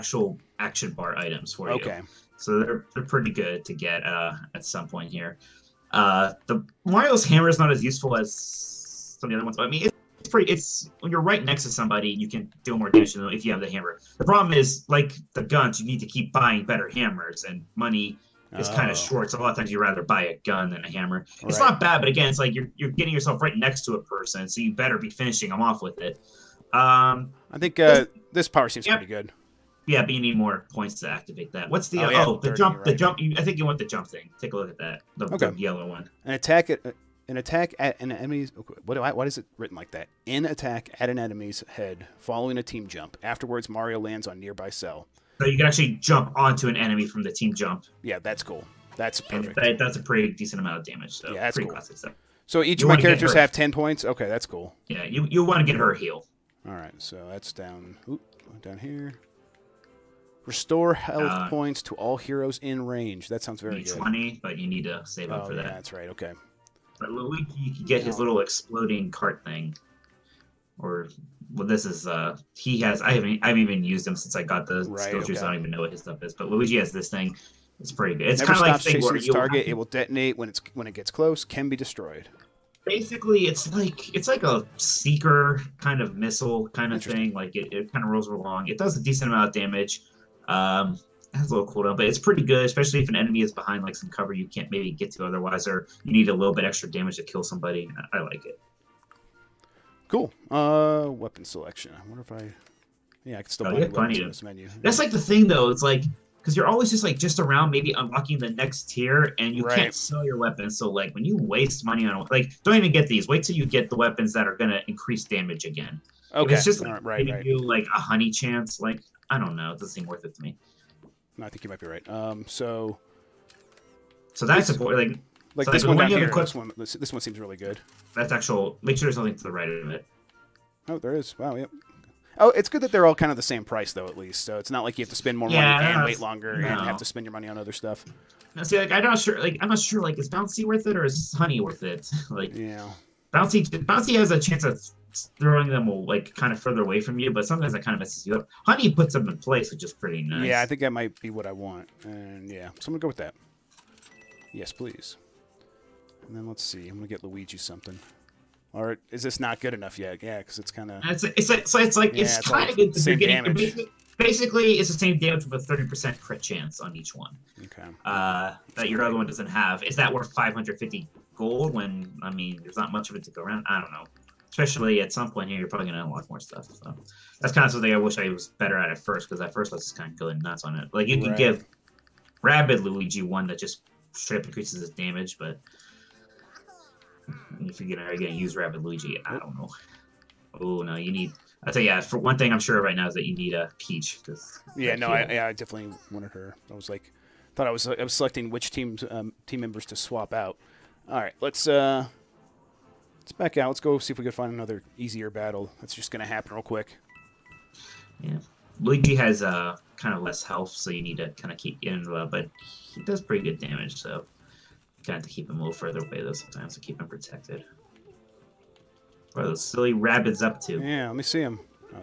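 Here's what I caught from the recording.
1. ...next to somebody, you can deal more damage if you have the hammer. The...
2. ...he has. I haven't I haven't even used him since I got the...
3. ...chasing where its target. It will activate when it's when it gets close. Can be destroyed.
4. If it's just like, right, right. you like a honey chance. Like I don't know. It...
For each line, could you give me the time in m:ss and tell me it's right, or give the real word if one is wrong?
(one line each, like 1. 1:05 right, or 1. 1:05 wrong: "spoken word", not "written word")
1. 0:11 right
2. 1:12 right
3. 1:18 wrong: "detonate", not "activate"
4. 1:56 right.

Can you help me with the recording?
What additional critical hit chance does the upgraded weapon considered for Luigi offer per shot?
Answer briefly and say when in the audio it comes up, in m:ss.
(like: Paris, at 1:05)
30 percent, at 2:45.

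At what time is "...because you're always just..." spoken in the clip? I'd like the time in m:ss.
1:46.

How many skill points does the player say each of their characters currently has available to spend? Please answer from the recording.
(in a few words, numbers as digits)
10.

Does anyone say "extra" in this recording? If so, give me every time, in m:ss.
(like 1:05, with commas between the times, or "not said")
1:36.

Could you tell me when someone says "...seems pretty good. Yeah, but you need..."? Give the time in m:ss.
0:28.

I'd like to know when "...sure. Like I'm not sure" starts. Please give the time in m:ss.
2:19.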